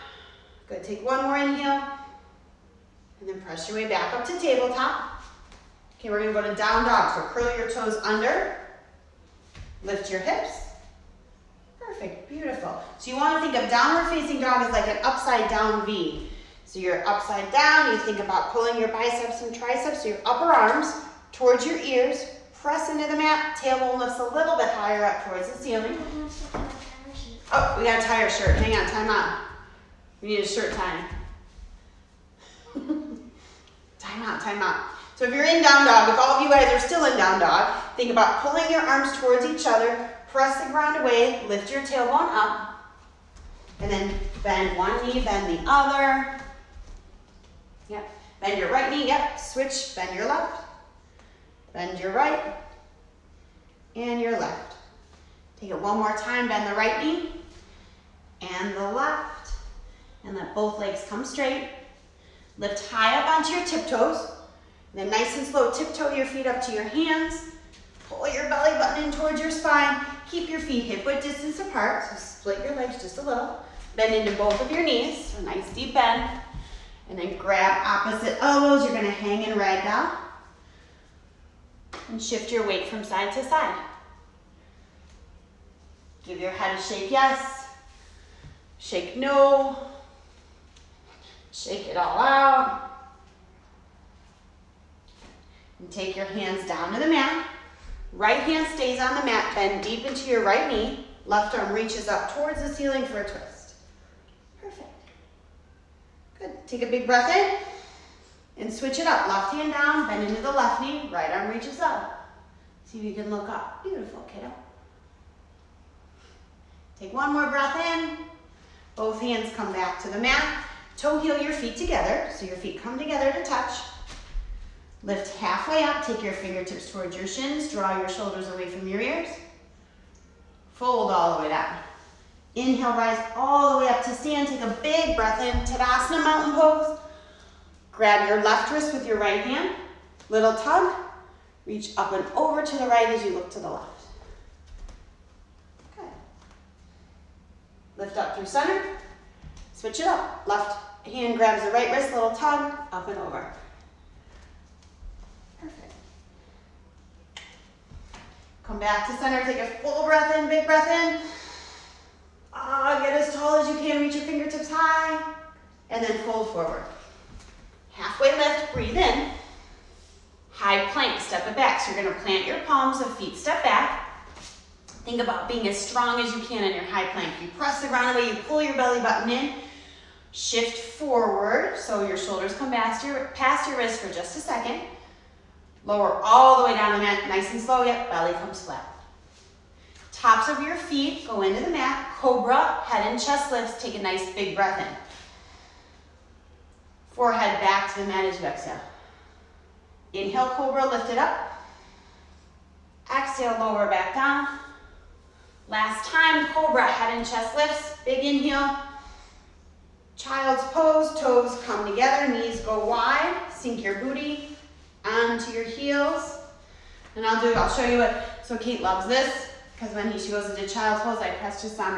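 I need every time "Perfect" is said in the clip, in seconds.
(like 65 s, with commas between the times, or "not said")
12 s, 104 s.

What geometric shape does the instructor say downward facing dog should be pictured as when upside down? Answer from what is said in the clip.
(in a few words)
Upside down V.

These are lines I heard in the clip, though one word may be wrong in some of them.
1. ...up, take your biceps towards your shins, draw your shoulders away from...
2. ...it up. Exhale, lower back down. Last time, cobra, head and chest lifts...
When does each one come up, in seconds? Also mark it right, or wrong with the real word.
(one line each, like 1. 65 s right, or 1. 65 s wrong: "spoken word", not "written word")
1. 125 s wrong: "fingertips", not "biceps"
2. 201 s right.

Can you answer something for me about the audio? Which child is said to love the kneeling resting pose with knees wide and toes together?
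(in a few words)
Kate.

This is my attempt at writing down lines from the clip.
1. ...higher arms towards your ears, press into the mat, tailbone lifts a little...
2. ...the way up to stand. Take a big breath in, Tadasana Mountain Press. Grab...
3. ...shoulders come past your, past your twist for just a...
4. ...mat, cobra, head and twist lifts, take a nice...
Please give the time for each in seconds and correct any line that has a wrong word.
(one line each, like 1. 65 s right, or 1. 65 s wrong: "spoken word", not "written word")
1. 20 s wrong: "upper", not "higher"
2. 133 s wrong: "Pose", not "Press"
3. 182 s wrong: "wrist", not "twist"
4. 191 s wrong: "chest", not "twist".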